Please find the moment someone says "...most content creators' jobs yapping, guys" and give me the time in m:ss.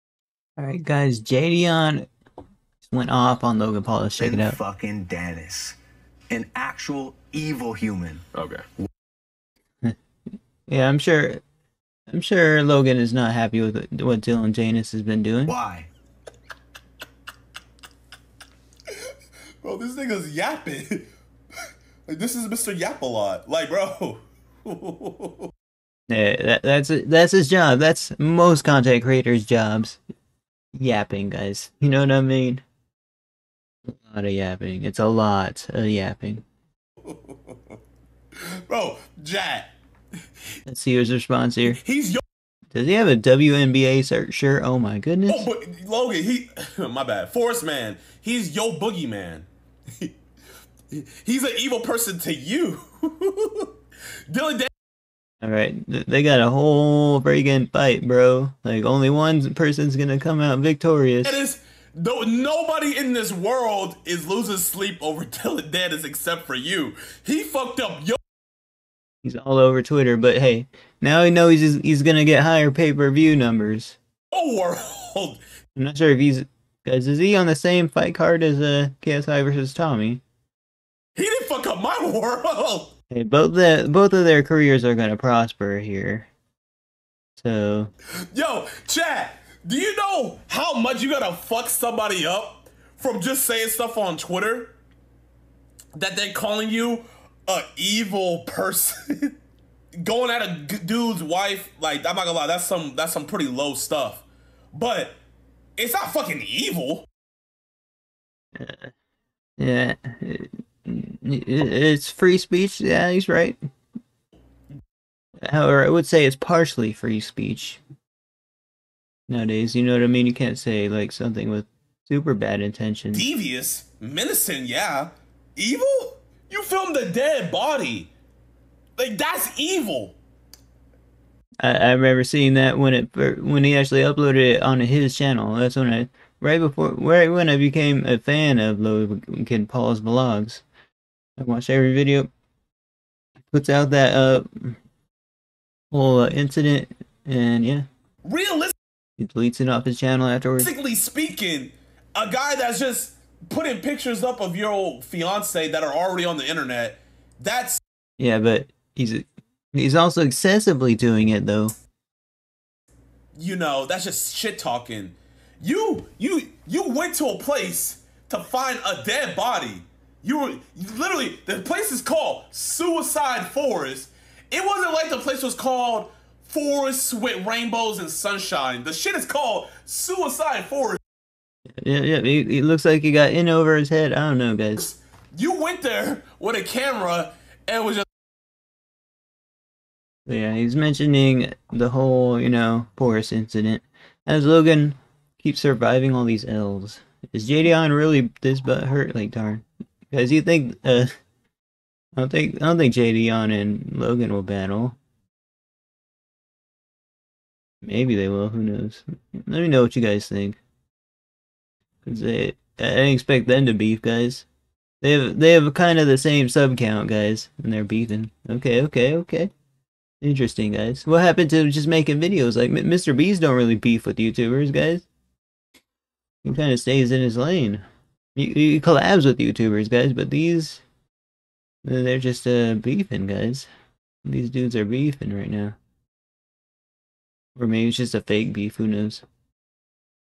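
0:28.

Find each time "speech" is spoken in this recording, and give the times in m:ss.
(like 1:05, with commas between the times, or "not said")
1:52, 1:57.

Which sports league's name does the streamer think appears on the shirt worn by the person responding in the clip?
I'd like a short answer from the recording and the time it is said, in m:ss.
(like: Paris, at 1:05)
WNBA, at 0:43.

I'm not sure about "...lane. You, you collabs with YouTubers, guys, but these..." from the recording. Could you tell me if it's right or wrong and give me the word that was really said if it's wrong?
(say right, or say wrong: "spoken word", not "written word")
right.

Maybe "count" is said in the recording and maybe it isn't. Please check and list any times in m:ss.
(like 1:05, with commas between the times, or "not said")
3:36.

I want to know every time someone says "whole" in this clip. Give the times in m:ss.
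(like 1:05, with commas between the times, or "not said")
0:56, 2:25, 3:11.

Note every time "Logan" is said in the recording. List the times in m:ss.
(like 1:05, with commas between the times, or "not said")
0:03, 0:12, 0:45, 2:18, 3:14, 3:23.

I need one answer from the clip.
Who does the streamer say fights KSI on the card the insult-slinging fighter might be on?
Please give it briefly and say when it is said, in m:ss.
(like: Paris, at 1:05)
Tommy, at 1:19.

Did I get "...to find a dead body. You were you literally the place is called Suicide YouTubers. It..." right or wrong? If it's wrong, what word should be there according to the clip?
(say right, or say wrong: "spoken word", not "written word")
wrong: "Forest", not "YouTubers".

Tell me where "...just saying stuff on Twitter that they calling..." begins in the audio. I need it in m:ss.
1:33.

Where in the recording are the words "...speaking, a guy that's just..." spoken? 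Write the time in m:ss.
2:30.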